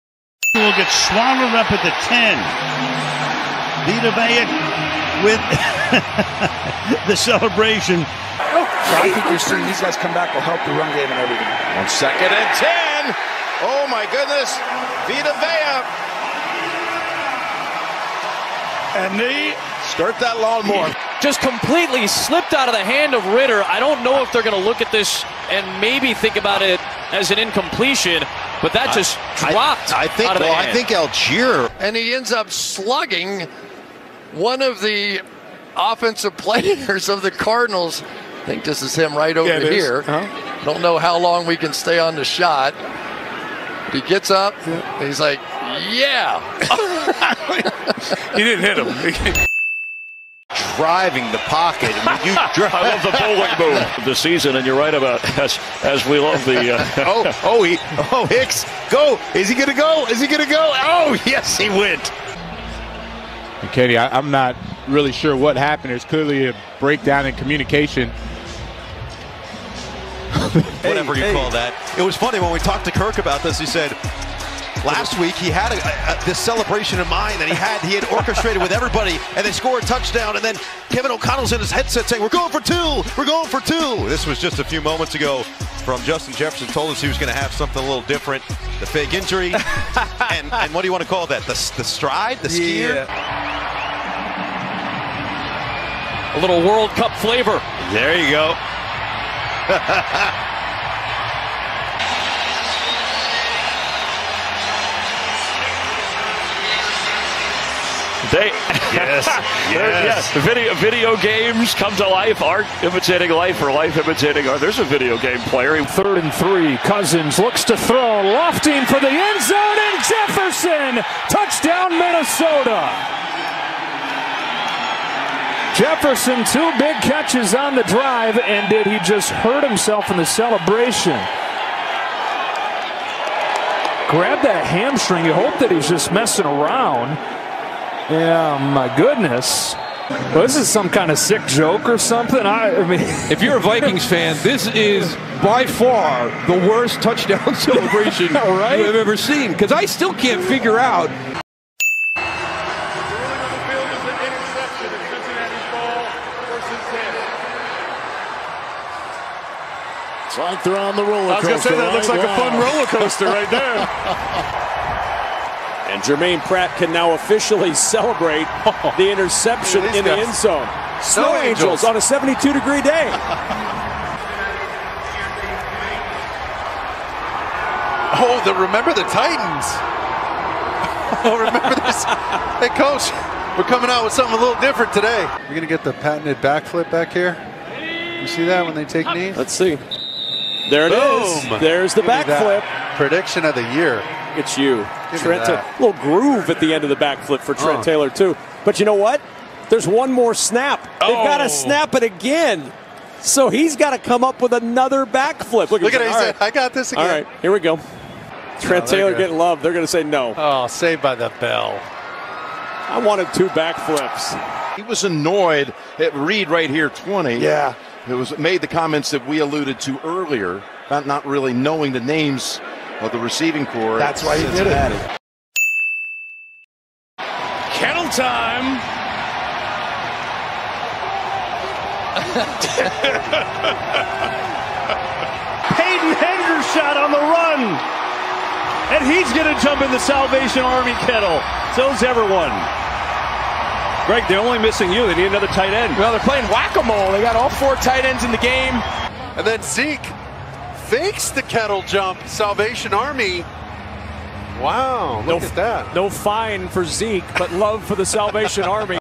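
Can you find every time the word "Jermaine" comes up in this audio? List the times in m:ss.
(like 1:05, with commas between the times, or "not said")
2:46.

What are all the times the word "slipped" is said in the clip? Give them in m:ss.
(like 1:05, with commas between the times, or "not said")
0:22.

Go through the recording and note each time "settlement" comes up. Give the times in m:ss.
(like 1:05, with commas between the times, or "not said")
not said.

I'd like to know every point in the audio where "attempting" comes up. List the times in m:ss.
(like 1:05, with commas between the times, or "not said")
not said.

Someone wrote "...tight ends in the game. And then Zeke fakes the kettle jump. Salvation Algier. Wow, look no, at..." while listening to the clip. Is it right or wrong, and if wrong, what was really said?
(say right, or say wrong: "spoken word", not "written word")
wrong: "Army", not "Algier".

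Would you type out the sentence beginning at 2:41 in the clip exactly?
I was going to say, that right?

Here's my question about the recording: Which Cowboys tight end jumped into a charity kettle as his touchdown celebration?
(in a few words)
Peyton Hendershot.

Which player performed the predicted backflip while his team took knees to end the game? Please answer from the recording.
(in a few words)
Trent Taylor.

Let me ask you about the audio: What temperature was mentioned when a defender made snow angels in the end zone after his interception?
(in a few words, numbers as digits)
72 degrees.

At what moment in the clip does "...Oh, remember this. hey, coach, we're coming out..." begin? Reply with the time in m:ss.
3:01.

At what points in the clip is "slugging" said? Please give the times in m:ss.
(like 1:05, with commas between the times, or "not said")
0:32.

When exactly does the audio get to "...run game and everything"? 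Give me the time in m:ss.
0:10.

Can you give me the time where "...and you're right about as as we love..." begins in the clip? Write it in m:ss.
0:54.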